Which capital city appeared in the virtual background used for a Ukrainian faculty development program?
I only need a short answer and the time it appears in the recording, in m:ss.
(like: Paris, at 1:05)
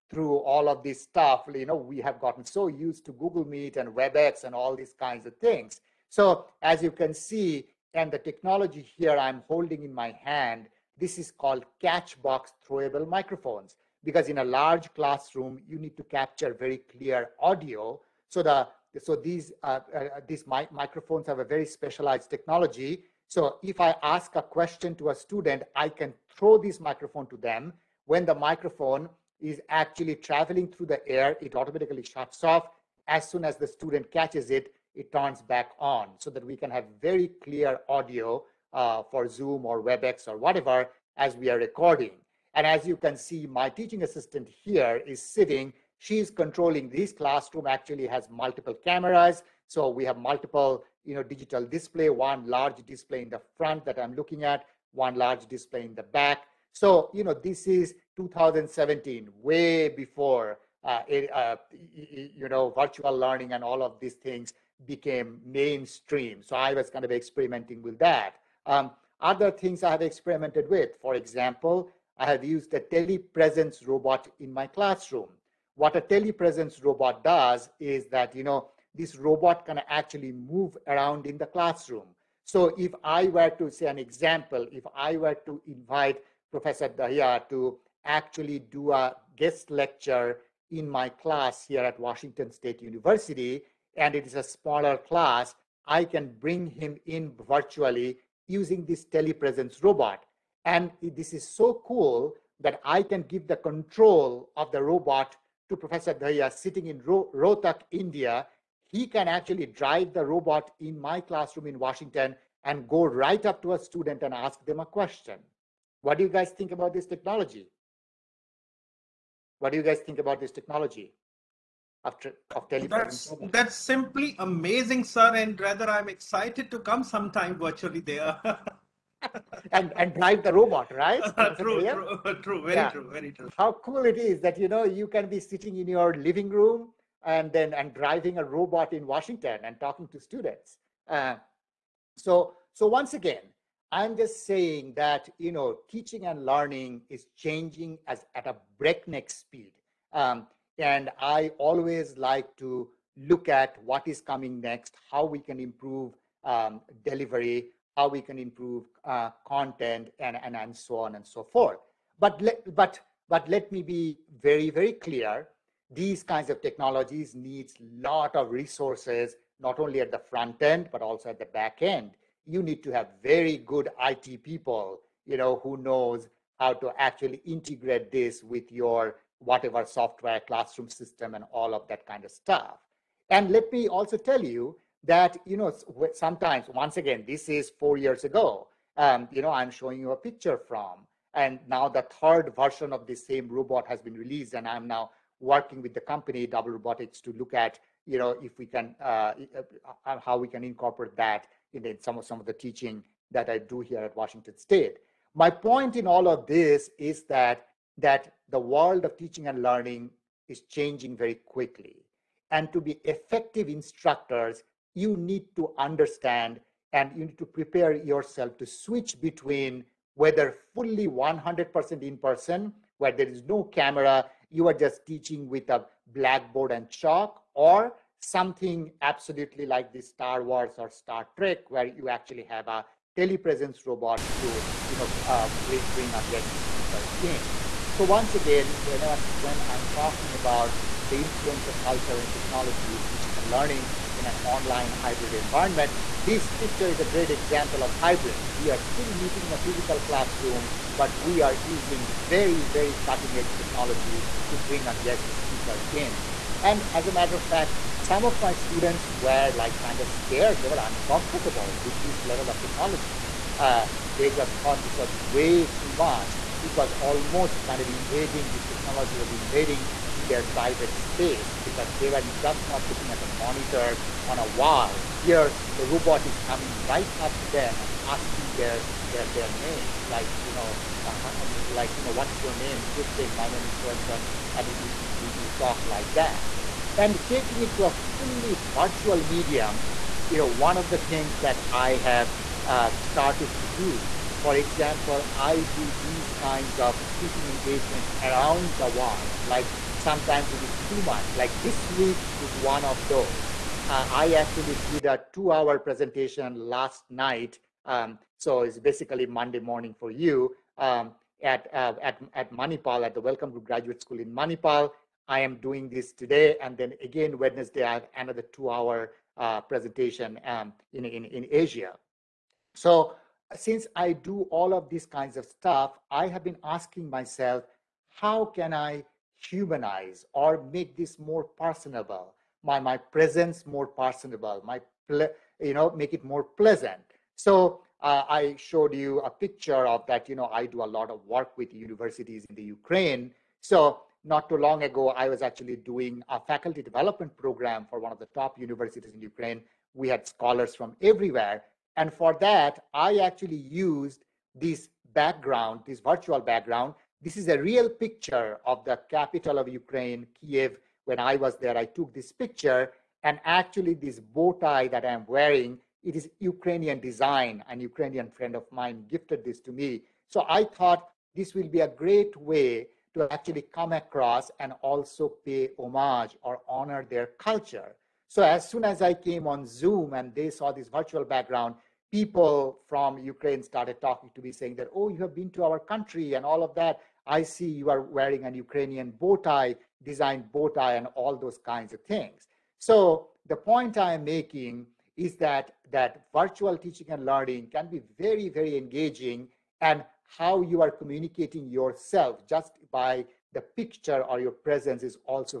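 Kiev, at 6:00.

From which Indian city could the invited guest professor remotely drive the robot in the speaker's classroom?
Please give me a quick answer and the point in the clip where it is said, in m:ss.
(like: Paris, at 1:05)
Rohtak, at 1:47.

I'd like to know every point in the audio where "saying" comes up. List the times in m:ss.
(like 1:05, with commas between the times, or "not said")
2:24, 6:24.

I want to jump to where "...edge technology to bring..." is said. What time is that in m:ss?
4:13.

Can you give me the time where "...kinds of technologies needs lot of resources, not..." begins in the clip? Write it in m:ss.
2:46.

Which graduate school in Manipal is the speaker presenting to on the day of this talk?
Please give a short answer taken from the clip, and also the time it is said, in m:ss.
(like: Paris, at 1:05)
Welcomgroup Graduate School, at 5:13.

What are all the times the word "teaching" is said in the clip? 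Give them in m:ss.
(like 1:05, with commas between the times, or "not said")
0:43, 2:25, 3:22, 3:29, 3:45, 4:03, 6:36.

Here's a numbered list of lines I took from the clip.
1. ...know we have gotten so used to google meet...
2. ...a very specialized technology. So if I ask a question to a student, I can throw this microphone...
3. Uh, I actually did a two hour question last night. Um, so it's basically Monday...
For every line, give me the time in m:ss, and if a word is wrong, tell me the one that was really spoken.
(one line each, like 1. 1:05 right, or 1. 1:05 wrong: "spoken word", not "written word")
1. 0:01 right
2. 0:21 right
3. 5:03 wrong: "presentation", not "question".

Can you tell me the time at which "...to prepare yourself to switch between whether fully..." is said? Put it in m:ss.
3:37.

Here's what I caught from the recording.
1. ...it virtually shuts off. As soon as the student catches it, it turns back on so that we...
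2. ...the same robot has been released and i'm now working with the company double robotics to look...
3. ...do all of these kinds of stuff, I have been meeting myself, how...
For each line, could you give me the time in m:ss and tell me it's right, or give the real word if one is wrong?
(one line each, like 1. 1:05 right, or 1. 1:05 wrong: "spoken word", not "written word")
1. 0:31 wrong: "automatically", not "virtually"
2. 3:13 right
3. 5:24 wrong: "asking", not "meeting".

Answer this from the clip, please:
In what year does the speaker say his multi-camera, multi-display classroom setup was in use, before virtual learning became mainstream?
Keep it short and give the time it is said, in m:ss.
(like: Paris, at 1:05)
2017, at 0:58.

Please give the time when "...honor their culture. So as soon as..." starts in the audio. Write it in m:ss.
6:16.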